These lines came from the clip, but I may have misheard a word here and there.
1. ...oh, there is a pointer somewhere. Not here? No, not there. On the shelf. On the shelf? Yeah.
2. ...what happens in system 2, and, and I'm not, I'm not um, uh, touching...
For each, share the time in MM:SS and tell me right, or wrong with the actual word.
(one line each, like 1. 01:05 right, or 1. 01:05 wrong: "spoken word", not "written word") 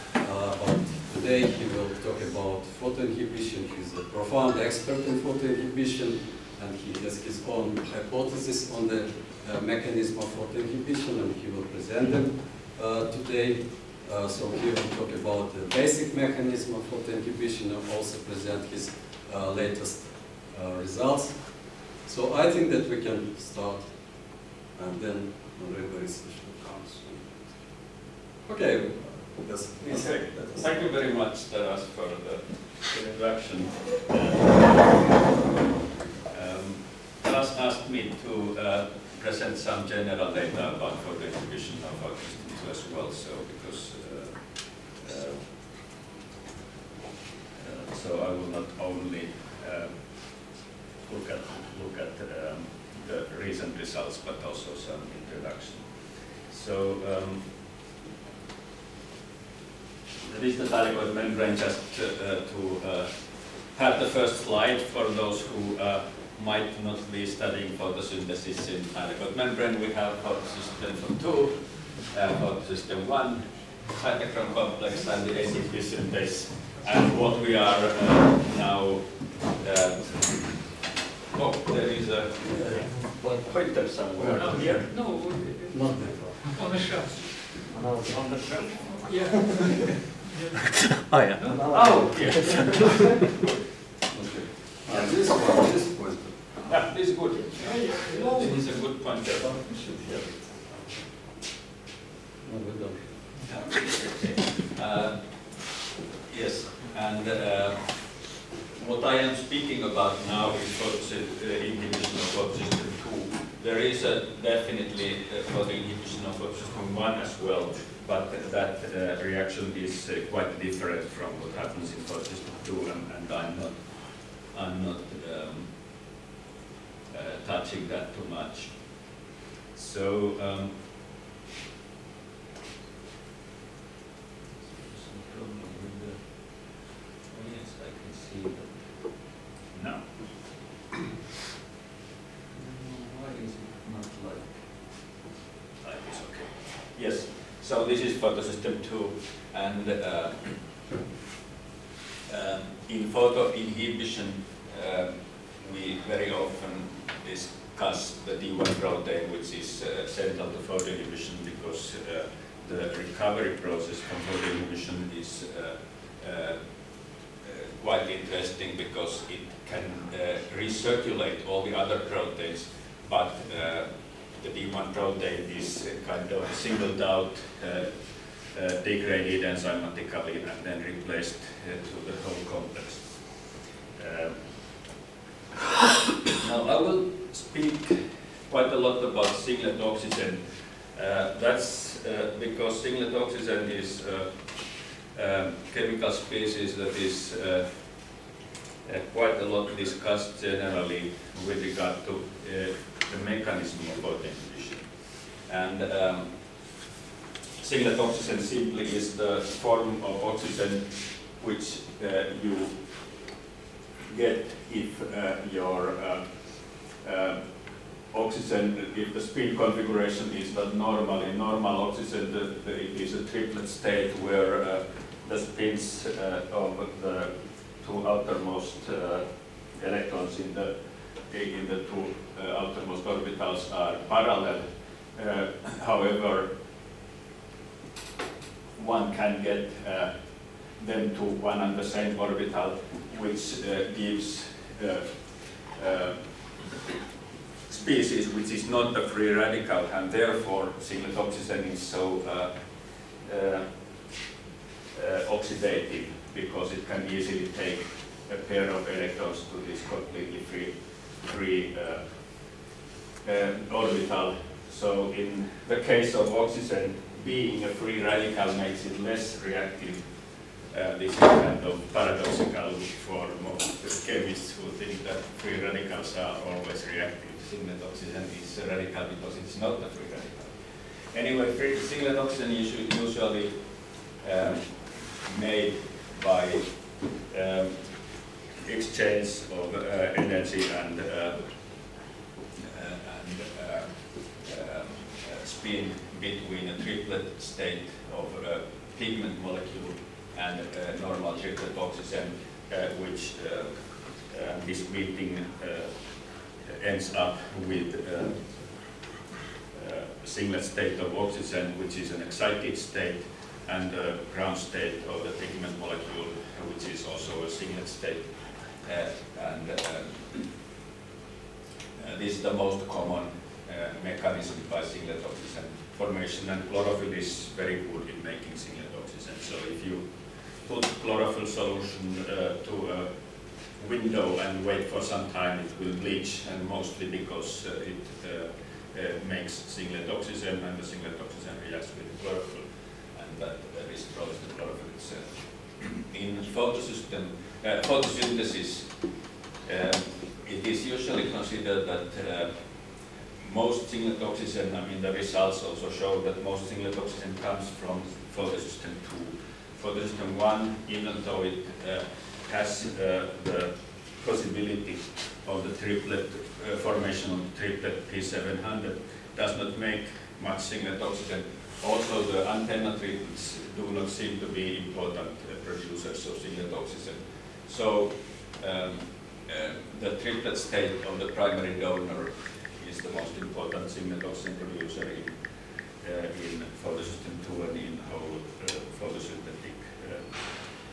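1. 01:21 right
2. 02:01 right.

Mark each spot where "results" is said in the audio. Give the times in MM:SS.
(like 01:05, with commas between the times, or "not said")
00:20, 00:53, 05:55.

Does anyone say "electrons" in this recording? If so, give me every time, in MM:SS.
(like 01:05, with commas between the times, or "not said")
03:49, 04:18.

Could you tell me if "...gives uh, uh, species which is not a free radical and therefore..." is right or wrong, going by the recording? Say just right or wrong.
right.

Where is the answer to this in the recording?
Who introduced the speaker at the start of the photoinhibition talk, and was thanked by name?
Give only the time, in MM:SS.
00:31.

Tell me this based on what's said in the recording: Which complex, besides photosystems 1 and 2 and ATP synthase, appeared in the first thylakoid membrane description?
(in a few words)
Cytochrome complex.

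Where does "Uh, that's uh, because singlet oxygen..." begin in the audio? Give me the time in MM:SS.
03:10.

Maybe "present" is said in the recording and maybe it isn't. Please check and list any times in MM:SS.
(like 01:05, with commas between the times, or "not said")
00:11, 00:18, 00:39.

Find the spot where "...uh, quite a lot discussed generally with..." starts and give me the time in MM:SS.
03:18.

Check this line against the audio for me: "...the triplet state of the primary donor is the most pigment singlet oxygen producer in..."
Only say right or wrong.
wrong.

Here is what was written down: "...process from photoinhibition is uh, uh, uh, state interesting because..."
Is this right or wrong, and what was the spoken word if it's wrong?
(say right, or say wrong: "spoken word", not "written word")
wrong: "quite", not "state".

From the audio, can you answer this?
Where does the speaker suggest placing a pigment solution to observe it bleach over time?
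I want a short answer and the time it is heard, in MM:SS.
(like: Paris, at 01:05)
A window, at 05:32.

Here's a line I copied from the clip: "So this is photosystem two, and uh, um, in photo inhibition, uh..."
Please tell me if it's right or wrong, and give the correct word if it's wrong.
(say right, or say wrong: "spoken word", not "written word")
right.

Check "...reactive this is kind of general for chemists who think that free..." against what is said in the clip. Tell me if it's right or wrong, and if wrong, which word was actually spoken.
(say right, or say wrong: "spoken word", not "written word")
wrong: "paradoxical", not "general".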